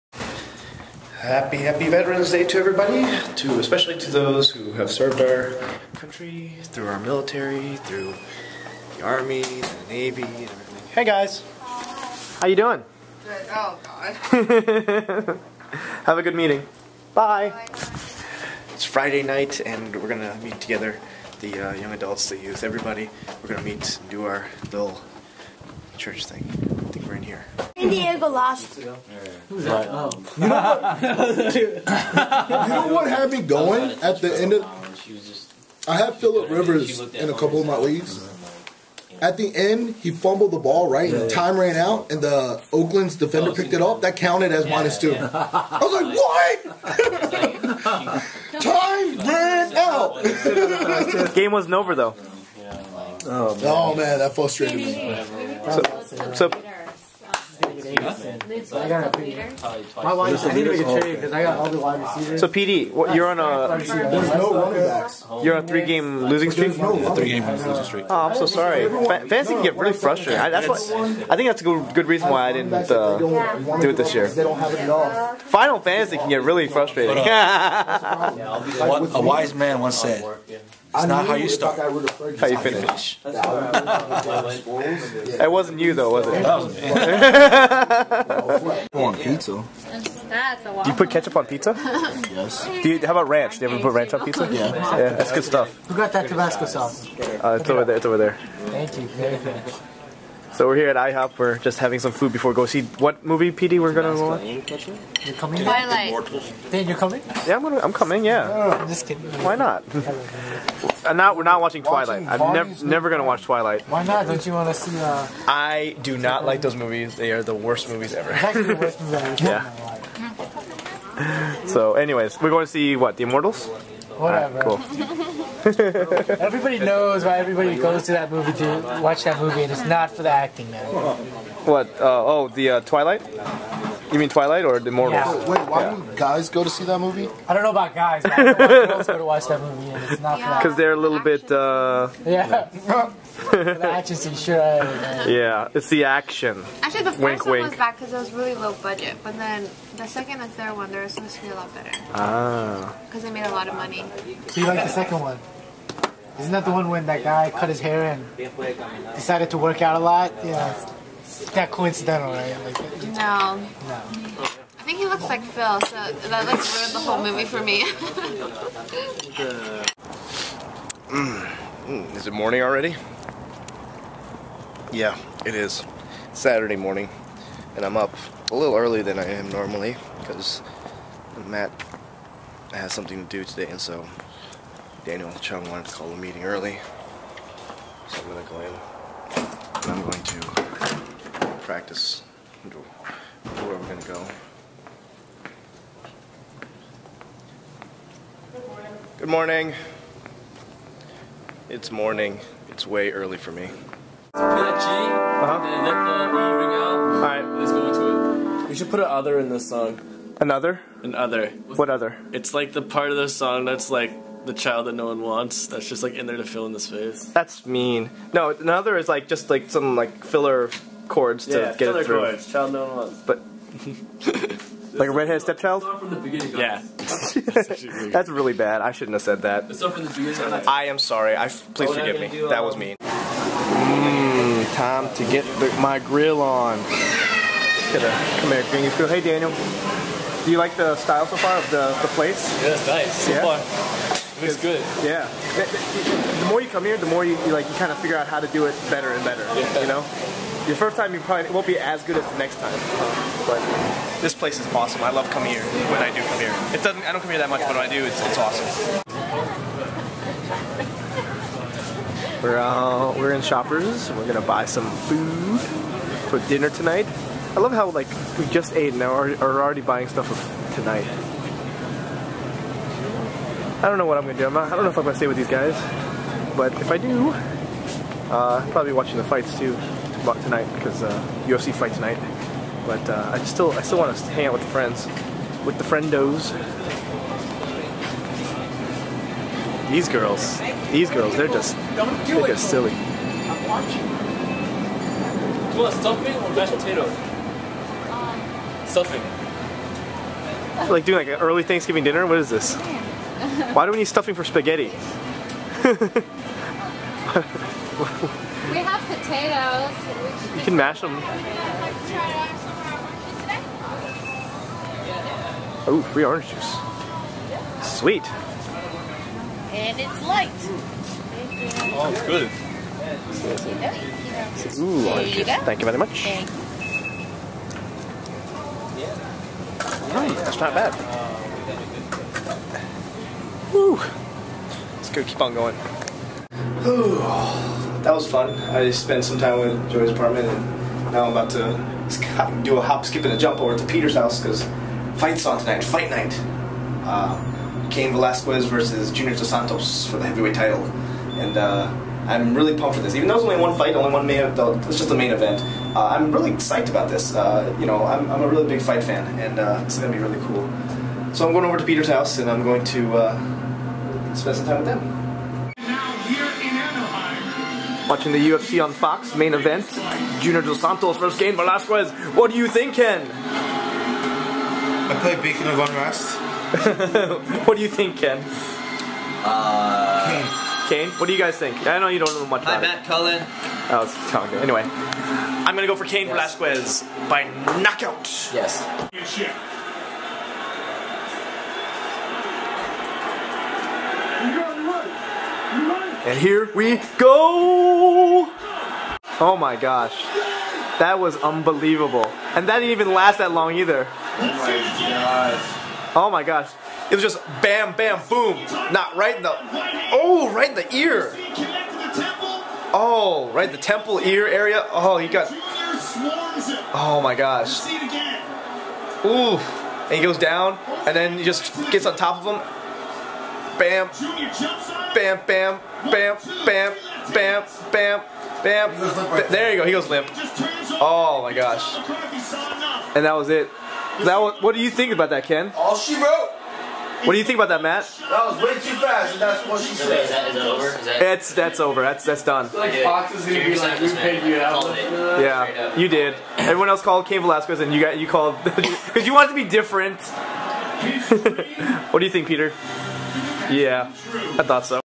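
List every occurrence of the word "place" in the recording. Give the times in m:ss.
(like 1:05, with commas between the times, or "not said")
4:02, 4:14.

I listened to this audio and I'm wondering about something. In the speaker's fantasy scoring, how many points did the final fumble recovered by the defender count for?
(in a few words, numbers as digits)
-2.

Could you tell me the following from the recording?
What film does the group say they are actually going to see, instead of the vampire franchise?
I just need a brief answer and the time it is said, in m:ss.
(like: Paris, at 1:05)
Immortals, at 2:03.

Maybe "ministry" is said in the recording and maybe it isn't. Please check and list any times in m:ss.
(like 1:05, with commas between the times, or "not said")
not said.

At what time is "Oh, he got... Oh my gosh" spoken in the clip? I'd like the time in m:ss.
6:54.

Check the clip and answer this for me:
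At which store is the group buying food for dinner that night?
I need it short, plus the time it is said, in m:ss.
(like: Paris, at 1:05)
Shoppers, at 4:23.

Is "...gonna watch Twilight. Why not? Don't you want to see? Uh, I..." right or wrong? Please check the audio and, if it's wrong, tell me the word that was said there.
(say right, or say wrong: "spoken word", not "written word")
right.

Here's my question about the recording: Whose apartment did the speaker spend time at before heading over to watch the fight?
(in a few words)
Joey's.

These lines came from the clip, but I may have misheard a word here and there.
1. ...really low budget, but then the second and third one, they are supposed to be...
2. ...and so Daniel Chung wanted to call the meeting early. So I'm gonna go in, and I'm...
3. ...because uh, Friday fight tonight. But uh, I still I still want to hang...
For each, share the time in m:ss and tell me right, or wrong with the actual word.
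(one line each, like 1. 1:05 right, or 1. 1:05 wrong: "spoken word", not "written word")
1. 2:28 right
2. 3:03 right
3. 4:40 wrong: "UFC", not "Friday".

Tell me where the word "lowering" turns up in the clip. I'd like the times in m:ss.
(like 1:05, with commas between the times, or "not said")
not said.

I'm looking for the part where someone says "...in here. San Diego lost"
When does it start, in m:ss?
0:27.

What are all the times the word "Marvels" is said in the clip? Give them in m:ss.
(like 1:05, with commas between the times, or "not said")
2:14.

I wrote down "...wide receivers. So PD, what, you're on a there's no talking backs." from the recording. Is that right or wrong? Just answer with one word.
wrong.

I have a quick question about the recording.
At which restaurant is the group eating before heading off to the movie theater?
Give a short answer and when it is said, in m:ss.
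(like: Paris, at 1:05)
IHOP, at 1:40.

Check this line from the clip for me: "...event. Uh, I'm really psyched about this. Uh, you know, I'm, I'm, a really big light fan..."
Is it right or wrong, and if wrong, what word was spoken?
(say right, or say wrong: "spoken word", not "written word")
wrong: "fight", not "light".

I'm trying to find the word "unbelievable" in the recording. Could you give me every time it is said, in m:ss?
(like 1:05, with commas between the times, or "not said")
6:41.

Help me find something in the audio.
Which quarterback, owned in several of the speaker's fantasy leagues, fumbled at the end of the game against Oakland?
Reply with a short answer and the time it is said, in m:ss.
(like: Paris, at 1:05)
Philip Rivers, at 0:36.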